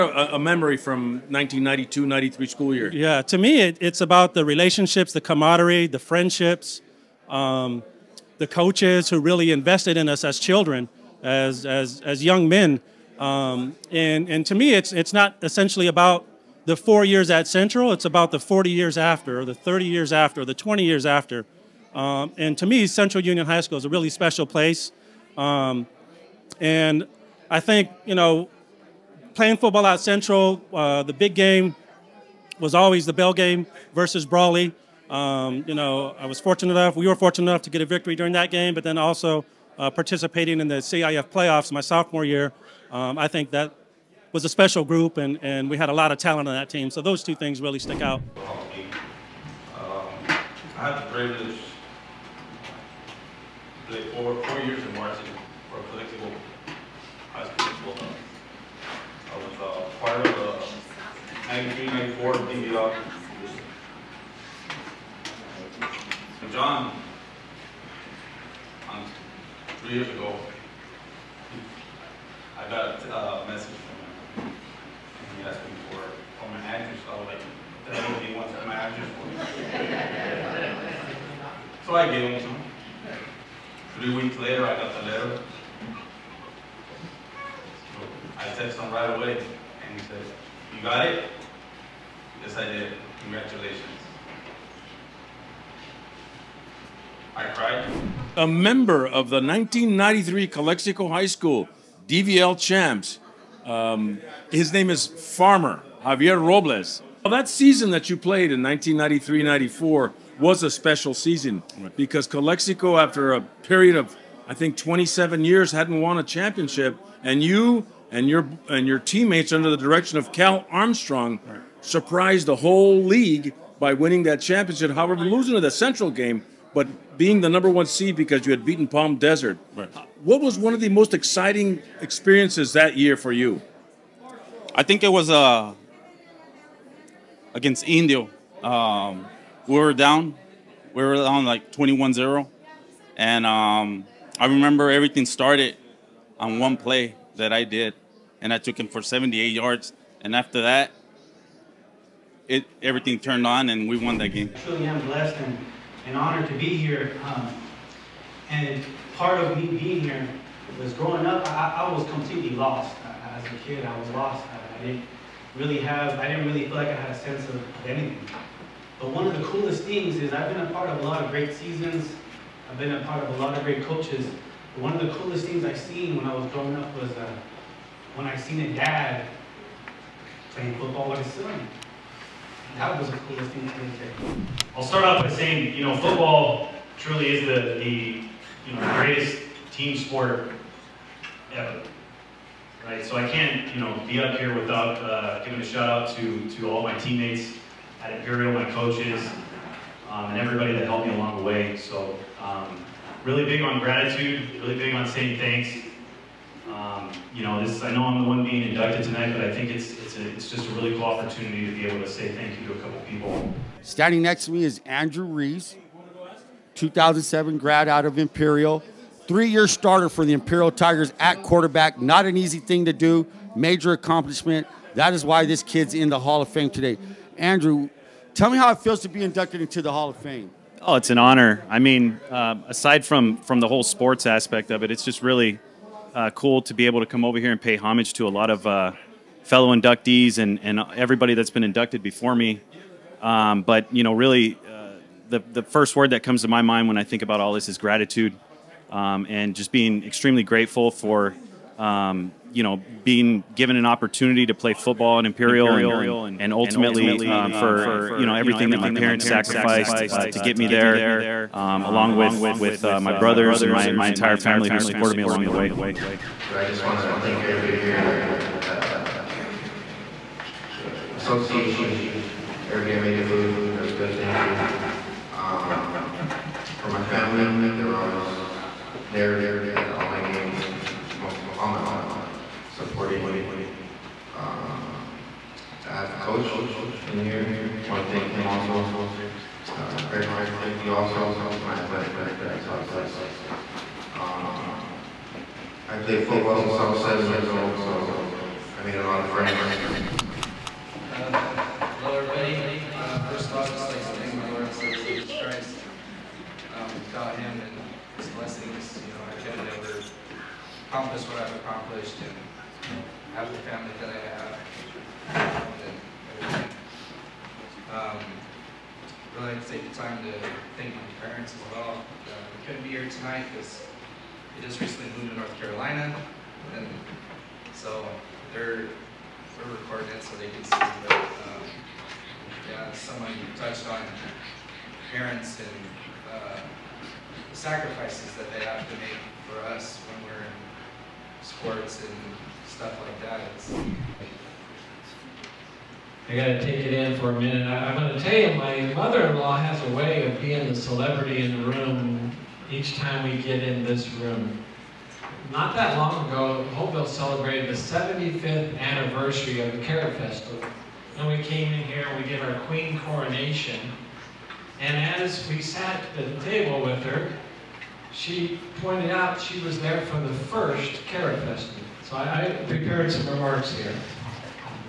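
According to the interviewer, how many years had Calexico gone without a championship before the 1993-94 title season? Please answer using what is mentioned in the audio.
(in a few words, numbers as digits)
27.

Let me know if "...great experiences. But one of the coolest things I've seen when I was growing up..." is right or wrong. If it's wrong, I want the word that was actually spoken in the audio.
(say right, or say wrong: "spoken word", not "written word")
wrong: "coaches", not "experiences".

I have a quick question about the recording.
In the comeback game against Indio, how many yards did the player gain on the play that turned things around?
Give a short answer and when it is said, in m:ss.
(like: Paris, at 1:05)
78, at 2:29.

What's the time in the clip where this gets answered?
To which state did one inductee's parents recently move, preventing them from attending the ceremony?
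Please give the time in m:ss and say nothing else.
5:25.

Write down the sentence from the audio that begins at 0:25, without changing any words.
Um, and I think, you know, playing football at Central, uh, the big game was always the bell game versus Brawley.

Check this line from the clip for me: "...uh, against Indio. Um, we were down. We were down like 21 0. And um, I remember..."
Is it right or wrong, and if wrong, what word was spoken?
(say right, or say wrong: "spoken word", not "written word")
right.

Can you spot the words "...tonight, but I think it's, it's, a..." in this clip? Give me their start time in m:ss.
3:29.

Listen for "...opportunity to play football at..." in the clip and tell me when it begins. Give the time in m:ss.
4:13.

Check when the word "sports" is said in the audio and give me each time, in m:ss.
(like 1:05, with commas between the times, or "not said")
3:09, 3:53, 5:41.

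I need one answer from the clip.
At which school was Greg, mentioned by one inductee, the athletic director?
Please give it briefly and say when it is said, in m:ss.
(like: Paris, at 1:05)
Southwest, at 4:52.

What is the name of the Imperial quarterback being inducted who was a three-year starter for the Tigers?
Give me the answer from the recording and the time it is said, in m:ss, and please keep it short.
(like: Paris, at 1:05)
Andrew Ruiz, at 3:34.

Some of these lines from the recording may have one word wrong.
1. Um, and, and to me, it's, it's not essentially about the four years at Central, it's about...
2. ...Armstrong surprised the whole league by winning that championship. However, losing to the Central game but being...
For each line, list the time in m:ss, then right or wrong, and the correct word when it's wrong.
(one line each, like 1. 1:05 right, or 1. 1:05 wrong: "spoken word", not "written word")
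1. 0:13 right
2. 2:00 right.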